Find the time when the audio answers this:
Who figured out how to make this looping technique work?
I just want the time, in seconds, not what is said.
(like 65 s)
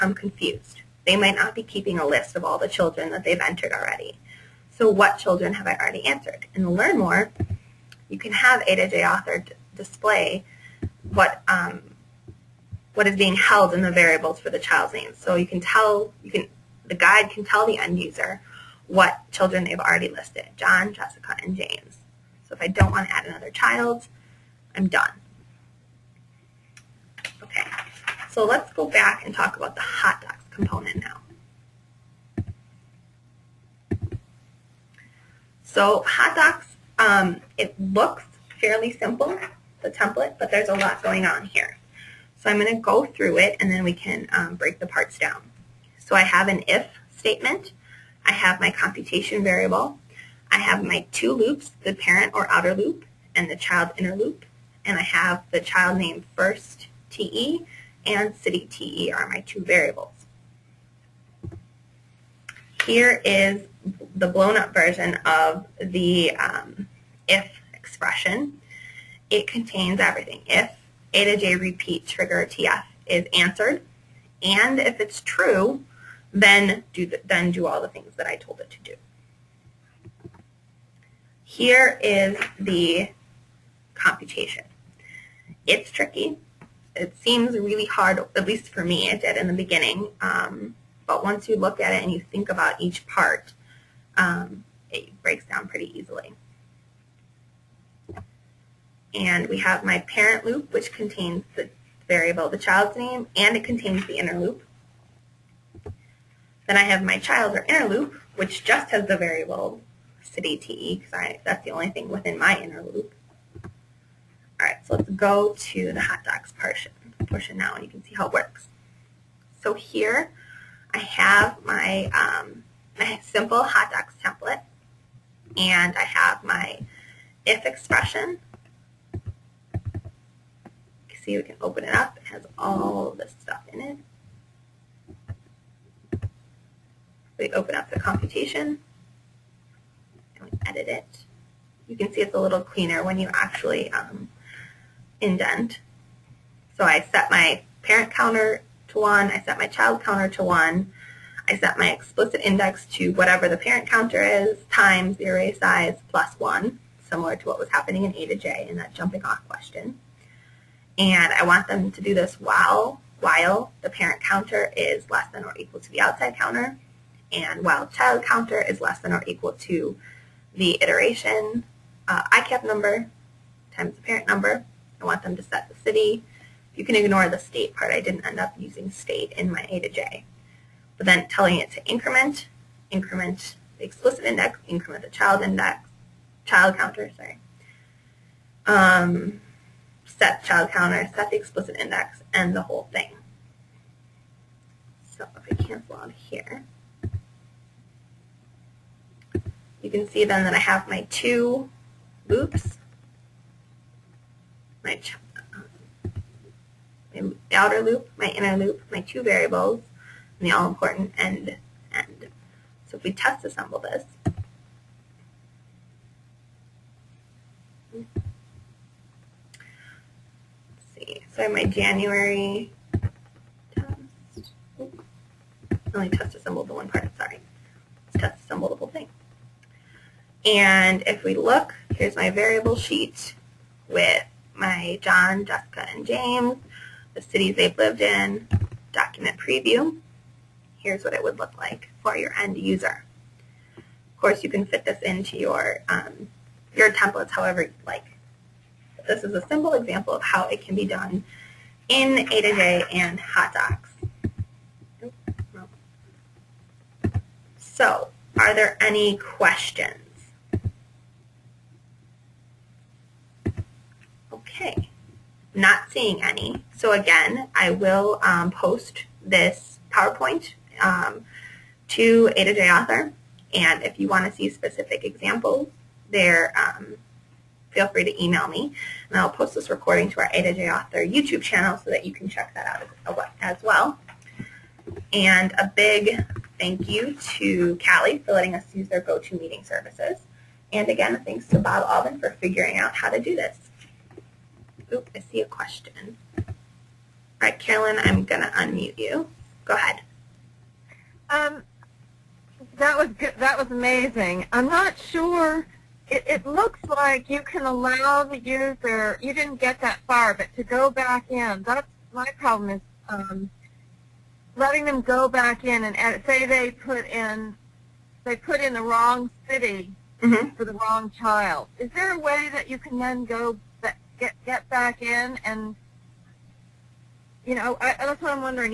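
291 s.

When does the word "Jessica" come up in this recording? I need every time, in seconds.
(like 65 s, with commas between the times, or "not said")
20 s, 235 s.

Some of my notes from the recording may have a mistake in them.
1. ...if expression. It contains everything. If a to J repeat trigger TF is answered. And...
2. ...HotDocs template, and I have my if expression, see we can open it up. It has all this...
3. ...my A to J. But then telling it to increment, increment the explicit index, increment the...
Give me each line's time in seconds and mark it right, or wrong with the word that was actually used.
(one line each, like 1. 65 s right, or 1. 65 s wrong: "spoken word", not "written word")
1. 67 s right
2. 123 s right
3. 179 s right.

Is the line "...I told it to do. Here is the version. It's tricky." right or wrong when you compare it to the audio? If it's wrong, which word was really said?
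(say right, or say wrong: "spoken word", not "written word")
wrong: "computation", not "version".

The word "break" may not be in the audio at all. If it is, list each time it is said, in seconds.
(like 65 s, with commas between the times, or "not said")
44 s, 95 s.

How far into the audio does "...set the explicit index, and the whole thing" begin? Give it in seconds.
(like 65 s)
191 s.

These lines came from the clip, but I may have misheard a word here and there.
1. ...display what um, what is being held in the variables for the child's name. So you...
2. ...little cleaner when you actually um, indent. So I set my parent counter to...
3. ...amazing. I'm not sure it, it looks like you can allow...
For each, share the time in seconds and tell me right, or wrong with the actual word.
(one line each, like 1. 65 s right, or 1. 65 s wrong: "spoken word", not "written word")
1. 9 s right
2. 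142 s right
3. 303 s right.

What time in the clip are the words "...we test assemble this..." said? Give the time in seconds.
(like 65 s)
213 s.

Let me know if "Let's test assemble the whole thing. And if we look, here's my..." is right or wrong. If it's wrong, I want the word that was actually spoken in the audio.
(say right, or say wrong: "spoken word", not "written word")
right.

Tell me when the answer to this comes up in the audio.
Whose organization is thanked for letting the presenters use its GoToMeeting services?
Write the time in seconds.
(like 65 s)
287 s.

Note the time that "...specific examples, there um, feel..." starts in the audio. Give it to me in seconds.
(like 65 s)
274 s.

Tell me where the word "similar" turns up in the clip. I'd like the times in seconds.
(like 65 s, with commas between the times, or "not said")
157 s.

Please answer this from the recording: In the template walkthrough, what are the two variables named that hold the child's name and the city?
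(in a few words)
child name first TE and city TE.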